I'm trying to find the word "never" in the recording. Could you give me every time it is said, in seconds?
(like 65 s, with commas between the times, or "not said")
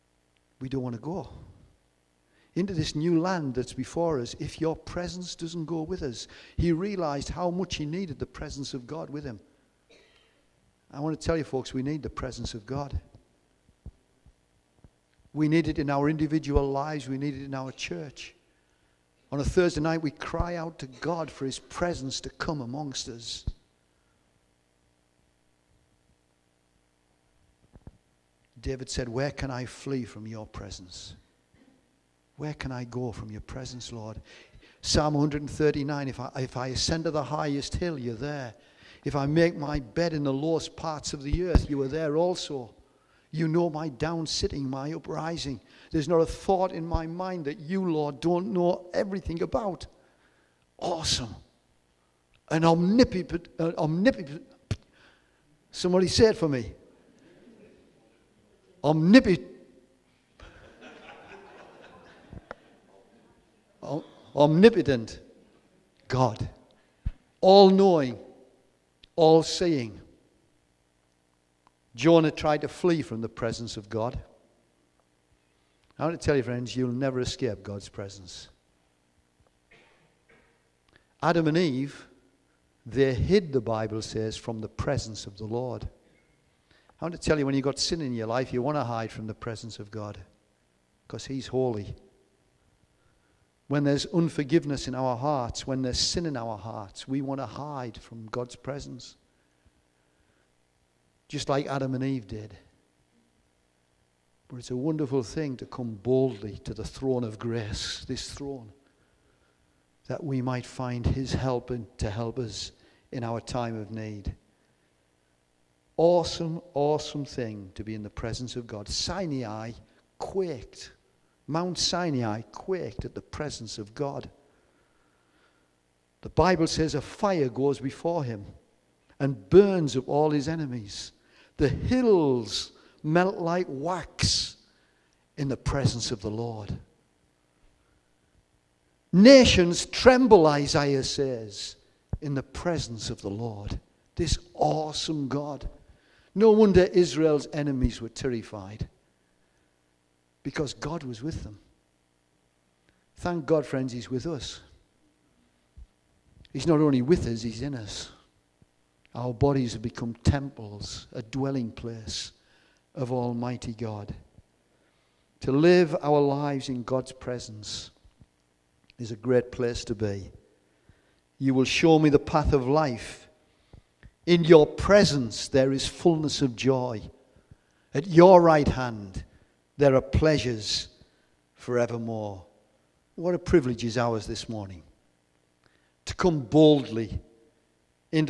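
76 s.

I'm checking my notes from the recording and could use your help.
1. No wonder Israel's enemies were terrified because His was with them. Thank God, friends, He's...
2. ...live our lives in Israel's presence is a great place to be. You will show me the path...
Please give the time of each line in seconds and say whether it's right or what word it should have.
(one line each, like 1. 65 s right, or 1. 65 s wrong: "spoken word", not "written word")
1. 146 s wrong: "God", not "His"
2. 165 s wrong: "God", not "Israel".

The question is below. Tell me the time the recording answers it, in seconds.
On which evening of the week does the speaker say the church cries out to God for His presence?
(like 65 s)
19 s.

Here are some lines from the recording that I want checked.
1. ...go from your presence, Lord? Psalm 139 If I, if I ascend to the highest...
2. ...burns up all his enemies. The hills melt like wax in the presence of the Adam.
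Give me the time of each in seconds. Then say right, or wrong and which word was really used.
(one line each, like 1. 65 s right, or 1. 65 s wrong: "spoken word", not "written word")
1. 32 s right
2. 129 s wrong: "Lord", not "Adam".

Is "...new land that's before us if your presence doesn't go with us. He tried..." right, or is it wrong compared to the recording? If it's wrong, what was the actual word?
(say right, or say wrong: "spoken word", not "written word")
wrong: "realized", not "tried".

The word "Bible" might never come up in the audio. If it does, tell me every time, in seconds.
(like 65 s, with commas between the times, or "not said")
83 s, 126 s.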